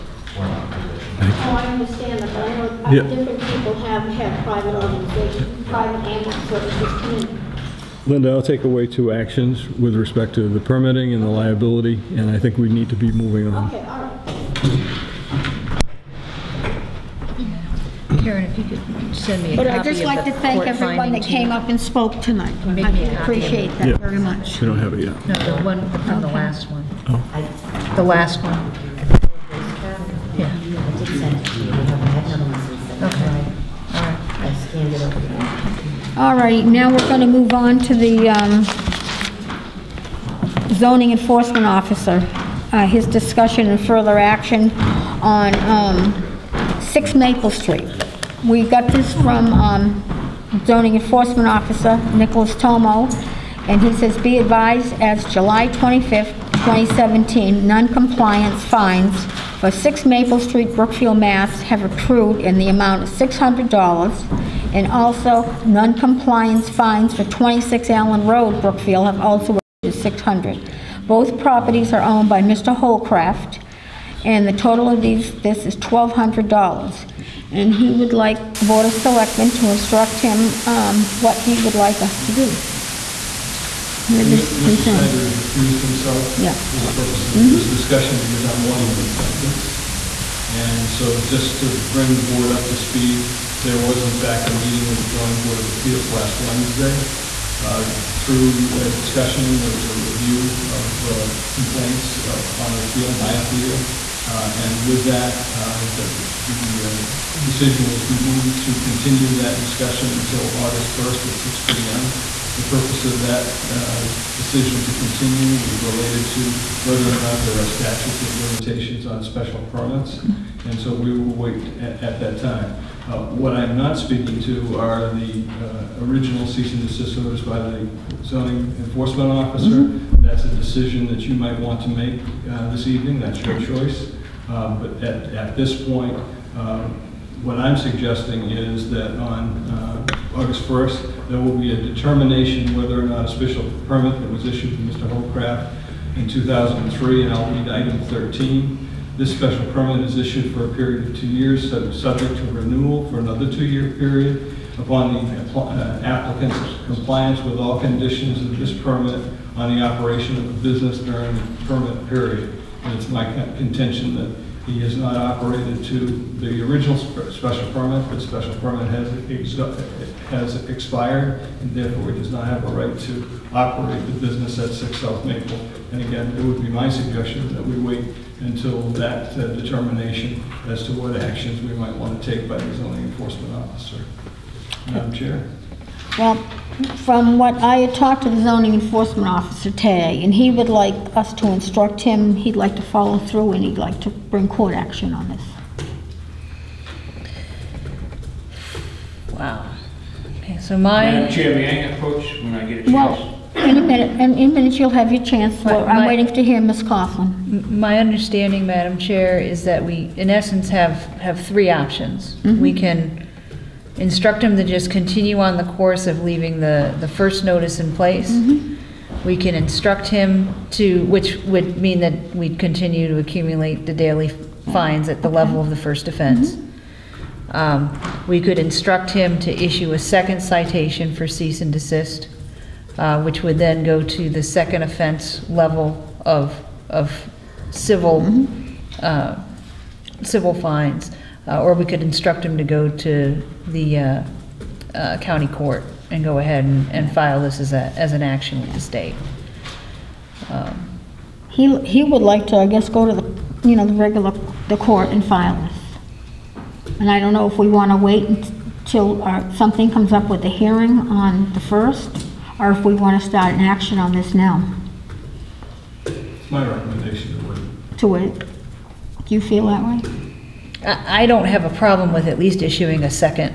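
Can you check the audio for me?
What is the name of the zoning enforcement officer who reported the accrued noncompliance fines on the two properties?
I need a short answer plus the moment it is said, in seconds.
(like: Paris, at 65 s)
Nicholas Tomo, at 52 s.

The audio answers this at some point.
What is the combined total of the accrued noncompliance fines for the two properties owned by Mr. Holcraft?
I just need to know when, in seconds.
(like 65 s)
75 s.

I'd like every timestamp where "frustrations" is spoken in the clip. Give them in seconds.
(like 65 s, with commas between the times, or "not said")
not said.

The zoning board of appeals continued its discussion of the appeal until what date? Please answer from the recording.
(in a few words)
August 1st.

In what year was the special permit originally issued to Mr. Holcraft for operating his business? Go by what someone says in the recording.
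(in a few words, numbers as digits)
2003.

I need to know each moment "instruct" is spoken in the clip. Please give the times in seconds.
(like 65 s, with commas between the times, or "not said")
79 s, 191 s, 214 s, 219 s, 228 s, 242 s.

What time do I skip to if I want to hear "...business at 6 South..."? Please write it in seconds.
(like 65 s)
174 s.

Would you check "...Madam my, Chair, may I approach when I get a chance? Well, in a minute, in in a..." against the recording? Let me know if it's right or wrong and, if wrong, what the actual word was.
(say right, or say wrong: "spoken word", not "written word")
right.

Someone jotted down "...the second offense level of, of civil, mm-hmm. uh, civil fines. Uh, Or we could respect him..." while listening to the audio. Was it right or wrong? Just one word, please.
wrong.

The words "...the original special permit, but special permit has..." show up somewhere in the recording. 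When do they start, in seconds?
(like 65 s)
166 s.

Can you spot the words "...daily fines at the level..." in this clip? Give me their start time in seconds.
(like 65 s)
223 s.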